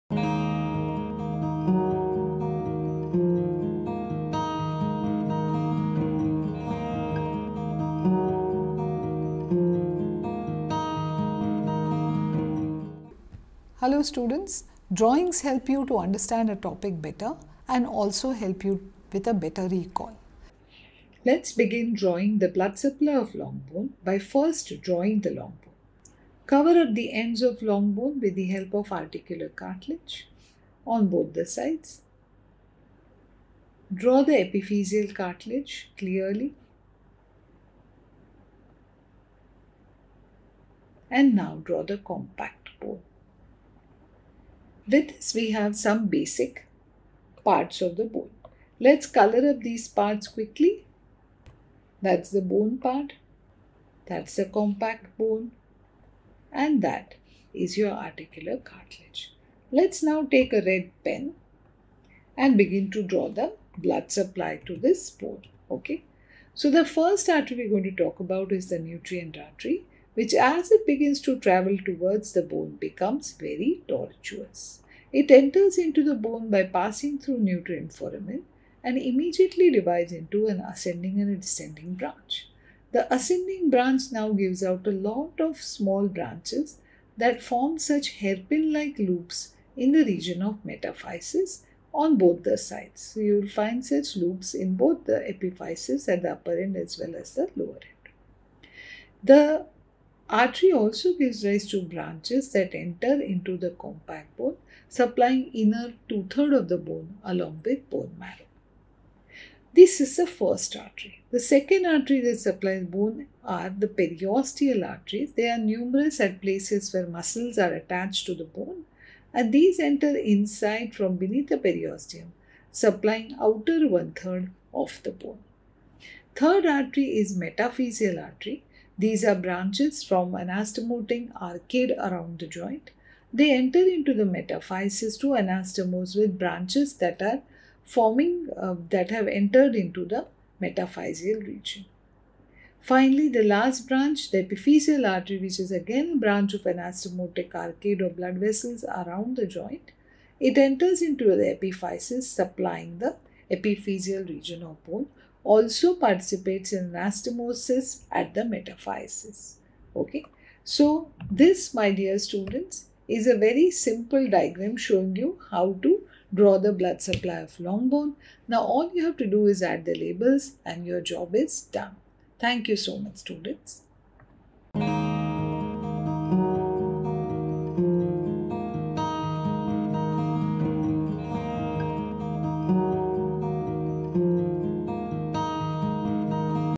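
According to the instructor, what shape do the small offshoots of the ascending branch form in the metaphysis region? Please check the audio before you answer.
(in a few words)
hairpin like loops.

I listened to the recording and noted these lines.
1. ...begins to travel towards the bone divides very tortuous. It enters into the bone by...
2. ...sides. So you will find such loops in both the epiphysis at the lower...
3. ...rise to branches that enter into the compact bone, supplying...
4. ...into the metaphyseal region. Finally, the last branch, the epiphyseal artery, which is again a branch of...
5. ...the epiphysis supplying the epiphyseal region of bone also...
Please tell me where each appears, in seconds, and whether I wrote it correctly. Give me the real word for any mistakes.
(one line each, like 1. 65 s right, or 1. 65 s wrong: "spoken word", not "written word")
1. 70 s wrong: "becomes", not "divides"
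2. 92 s wrong: "upper", not "lower"
3. 101 s right
4. 139 s right
5. 151 s right.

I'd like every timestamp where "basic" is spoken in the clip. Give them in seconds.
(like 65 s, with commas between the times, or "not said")
46 s.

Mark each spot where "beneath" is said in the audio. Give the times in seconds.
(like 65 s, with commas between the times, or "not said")
121 s.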